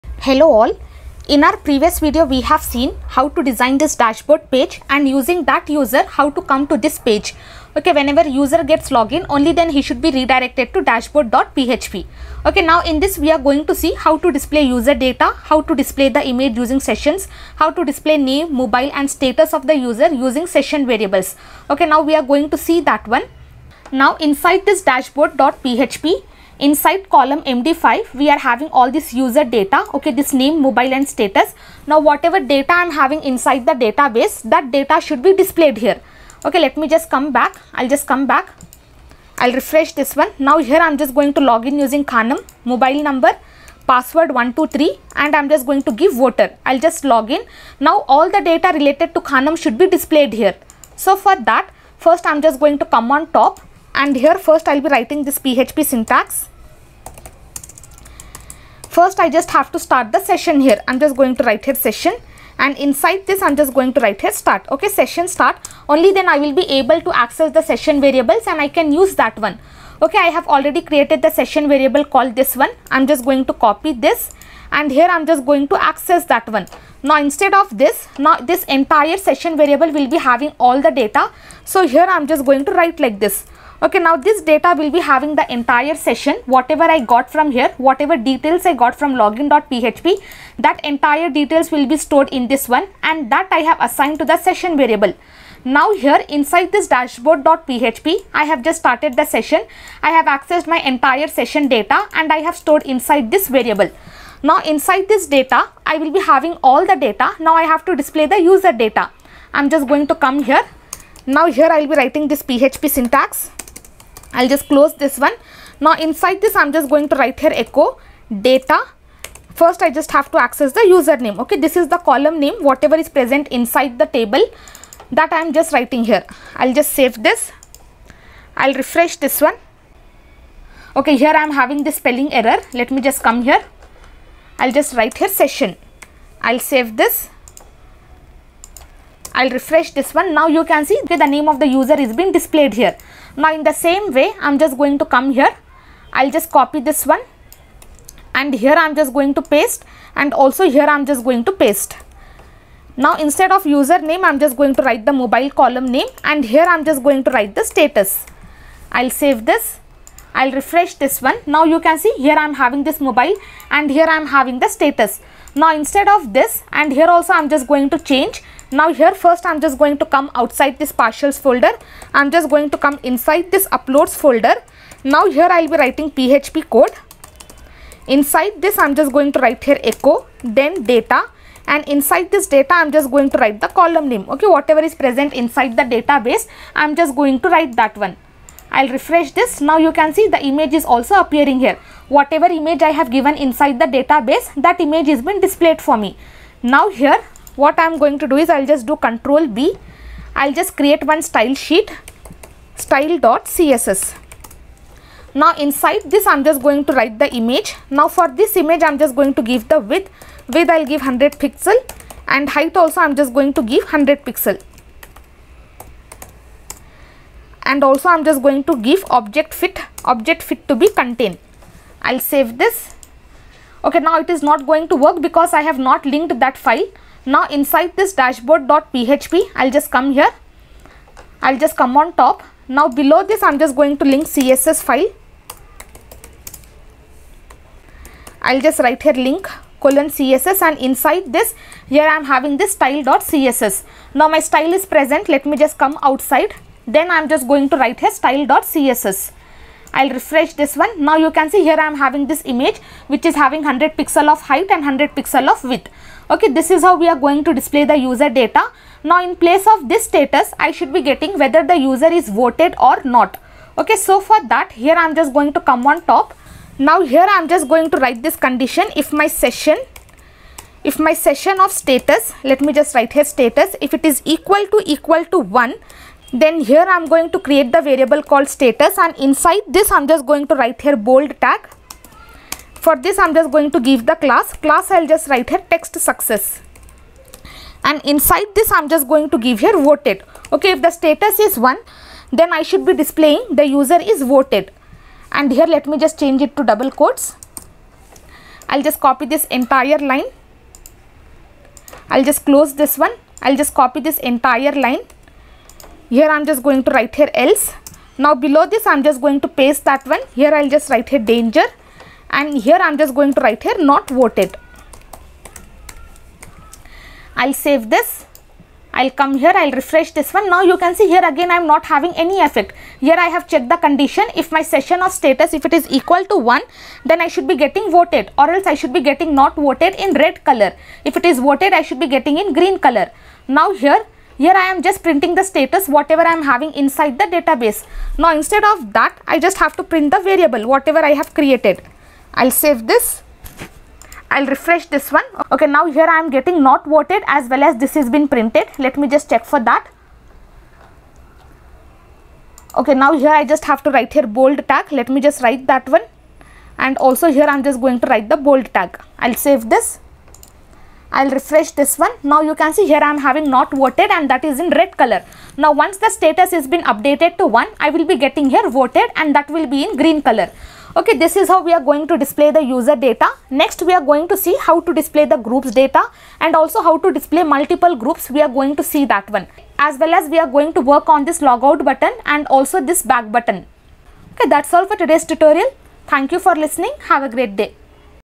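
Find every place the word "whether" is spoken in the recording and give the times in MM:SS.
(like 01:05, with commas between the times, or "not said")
04:21.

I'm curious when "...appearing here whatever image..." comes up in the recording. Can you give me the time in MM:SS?
03:11.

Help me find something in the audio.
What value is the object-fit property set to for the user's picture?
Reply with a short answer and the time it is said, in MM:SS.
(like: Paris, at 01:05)
contain, at 03:40.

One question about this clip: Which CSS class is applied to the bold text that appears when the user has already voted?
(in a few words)
text success.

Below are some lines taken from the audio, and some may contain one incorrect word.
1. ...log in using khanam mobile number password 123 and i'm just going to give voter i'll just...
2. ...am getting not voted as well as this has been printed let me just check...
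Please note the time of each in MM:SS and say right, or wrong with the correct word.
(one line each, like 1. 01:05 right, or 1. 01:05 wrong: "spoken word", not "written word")
1. 00:41 right
2. 05:46 right.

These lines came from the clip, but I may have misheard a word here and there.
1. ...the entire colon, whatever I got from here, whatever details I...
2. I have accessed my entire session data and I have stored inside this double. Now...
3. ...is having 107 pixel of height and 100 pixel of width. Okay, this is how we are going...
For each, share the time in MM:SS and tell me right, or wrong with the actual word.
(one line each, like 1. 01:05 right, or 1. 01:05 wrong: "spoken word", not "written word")
1. 01:25 wrong: "session", not "colon"
2. 01:40 wrong: "variable", not "double"
3. 04:13 wrong: "100", not "107".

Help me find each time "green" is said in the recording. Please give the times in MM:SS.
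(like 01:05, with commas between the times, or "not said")
05:32, 06:09.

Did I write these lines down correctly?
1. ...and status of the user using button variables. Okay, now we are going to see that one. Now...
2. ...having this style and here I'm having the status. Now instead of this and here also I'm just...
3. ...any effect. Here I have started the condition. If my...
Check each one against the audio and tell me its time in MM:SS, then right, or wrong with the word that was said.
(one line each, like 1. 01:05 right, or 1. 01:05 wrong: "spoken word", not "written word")
1. 00:18 wrong: "session", not "button"
2. 02:42 wrong: "mobile", not "style"
3. 05:22 wrong: "checked", not "started".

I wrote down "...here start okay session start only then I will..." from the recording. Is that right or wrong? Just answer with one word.
right.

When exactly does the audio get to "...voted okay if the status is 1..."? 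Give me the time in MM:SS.
04:49.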